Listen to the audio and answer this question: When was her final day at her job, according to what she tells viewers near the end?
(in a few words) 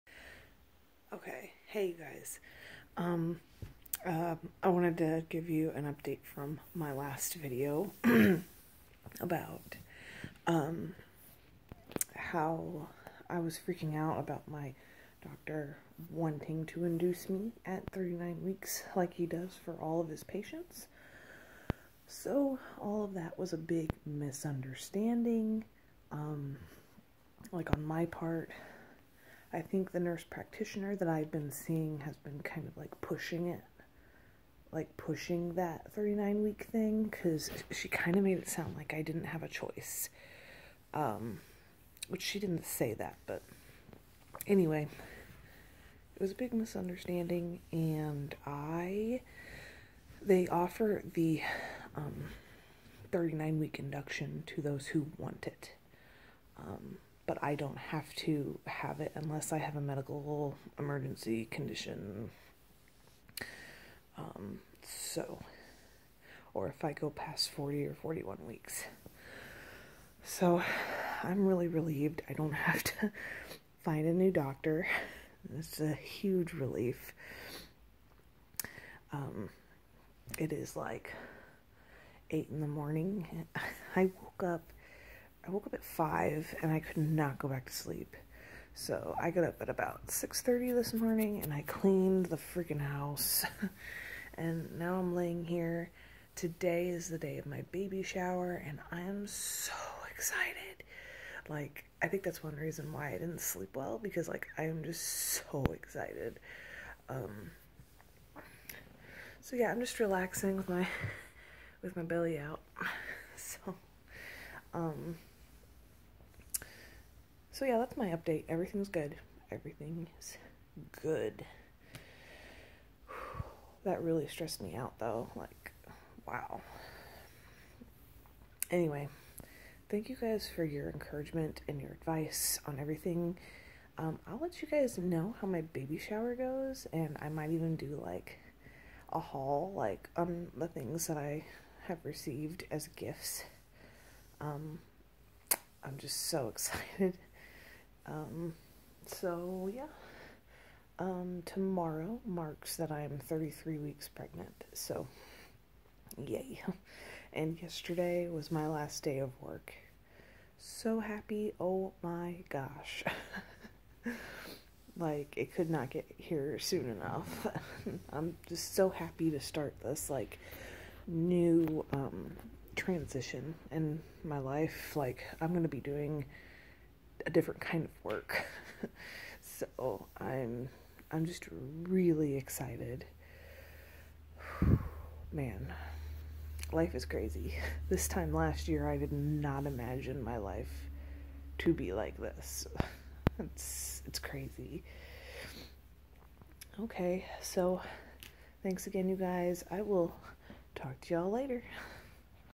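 yesterday.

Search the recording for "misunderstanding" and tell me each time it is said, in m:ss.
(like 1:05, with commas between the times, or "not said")
0:24, 0:46.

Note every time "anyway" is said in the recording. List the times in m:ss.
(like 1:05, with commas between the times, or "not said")
0:44, 2:08.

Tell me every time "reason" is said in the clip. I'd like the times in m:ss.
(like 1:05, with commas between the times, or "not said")
1:42.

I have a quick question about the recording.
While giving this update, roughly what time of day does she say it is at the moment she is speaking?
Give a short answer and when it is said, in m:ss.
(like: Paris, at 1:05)
8 in the morning, at 1:22.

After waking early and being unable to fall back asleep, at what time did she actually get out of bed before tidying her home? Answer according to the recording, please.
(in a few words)
6:30.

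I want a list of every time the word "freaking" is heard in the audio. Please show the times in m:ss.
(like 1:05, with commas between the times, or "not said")
0:13, 1:32.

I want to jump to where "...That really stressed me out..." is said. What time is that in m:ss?
2:03.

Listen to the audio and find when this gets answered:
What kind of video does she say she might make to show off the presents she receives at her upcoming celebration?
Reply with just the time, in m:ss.
2:19.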